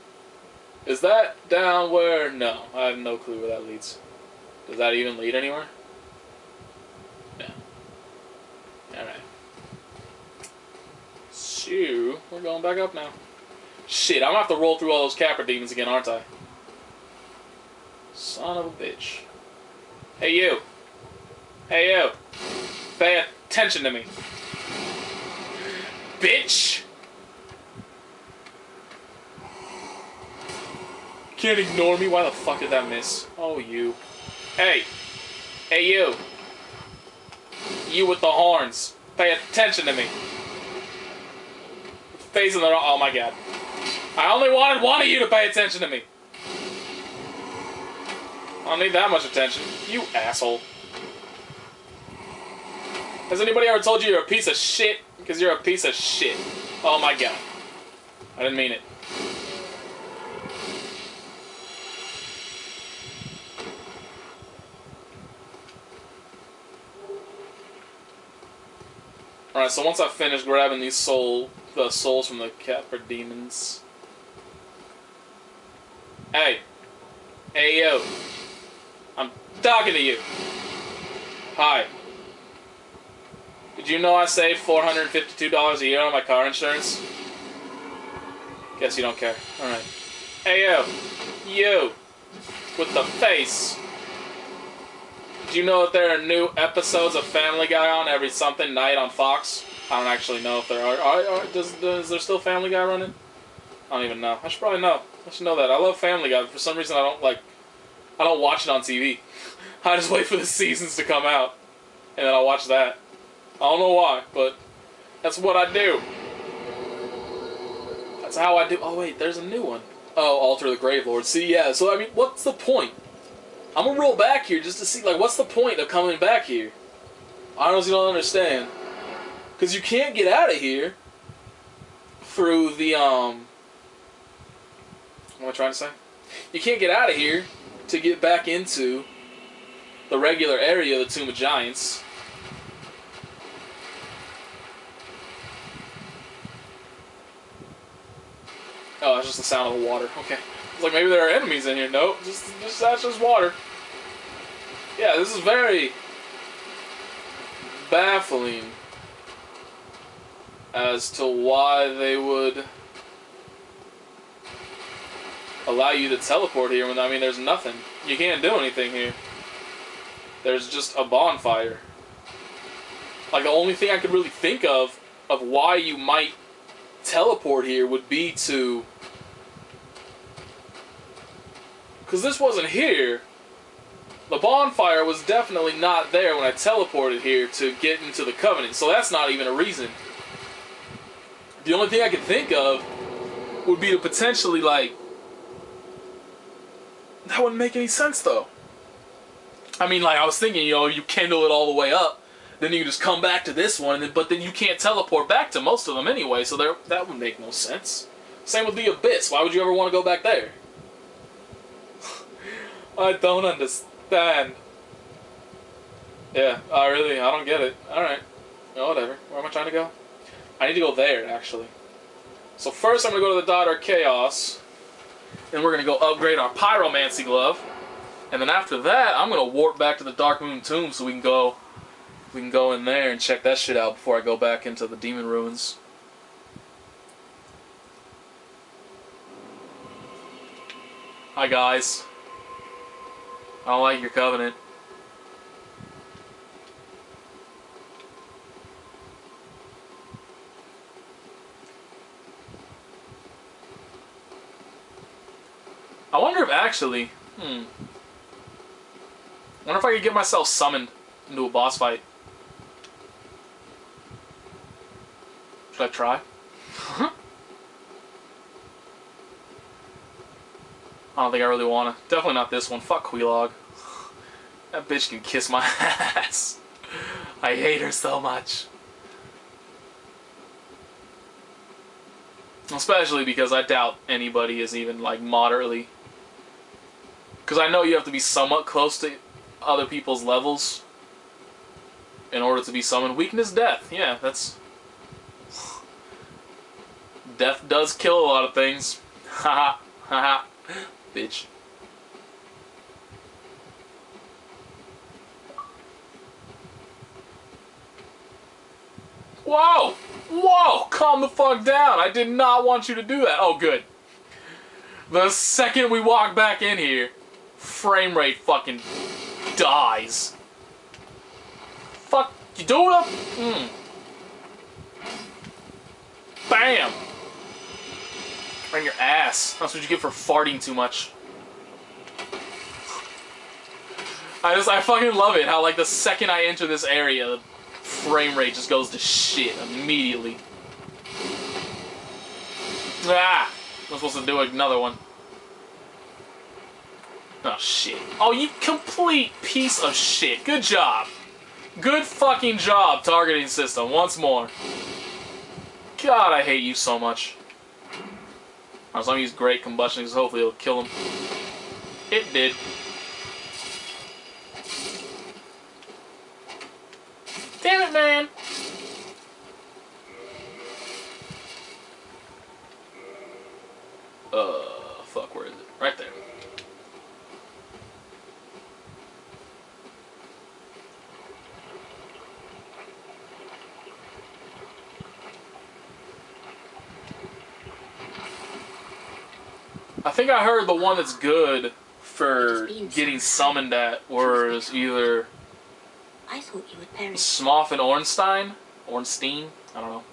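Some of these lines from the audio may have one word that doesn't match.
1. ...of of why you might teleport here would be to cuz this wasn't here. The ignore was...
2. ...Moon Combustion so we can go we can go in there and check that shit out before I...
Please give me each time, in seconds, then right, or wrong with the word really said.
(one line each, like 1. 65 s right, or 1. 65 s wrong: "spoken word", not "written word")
1. 174 s wrong: "bonfire", not "ignore"
2. 230 s wrong: "Tomb", not "Combustion".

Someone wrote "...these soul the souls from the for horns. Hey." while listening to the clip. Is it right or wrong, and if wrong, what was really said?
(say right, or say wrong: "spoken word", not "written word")
wrong: "demons", not "horns".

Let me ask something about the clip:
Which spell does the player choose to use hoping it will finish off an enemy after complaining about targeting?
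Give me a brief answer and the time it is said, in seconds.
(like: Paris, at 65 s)
Great Combustion, at 359 s.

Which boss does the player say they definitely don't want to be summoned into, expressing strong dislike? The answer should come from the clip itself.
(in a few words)
Quelaag.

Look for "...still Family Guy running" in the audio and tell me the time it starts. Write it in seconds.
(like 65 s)
102 s.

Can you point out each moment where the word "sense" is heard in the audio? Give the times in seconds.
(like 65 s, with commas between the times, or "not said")
197 s, 207 s.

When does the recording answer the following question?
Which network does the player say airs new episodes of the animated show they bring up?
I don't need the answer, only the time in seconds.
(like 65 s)
99 s.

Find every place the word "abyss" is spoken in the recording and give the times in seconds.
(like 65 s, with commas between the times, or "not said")
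208 s.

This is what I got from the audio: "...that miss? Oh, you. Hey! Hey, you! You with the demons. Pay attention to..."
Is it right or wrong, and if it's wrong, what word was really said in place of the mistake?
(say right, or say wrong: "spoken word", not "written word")
wrong: "horns", not "demons".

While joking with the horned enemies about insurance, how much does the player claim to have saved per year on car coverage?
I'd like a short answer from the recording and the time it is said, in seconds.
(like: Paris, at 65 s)
$452, at 84 s.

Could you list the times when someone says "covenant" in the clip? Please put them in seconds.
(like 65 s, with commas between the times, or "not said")
188 s, 244 s.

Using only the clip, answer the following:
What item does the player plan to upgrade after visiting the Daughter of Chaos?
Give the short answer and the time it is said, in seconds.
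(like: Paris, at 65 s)
Pyromancy Glove, at 226 s.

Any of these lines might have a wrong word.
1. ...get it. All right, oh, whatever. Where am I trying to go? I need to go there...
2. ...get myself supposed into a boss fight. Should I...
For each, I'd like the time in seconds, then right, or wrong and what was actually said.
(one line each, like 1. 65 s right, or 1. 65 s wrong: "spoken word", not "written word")
1. 217 s right
2. 260 s wrong: "summoned", not "supposed".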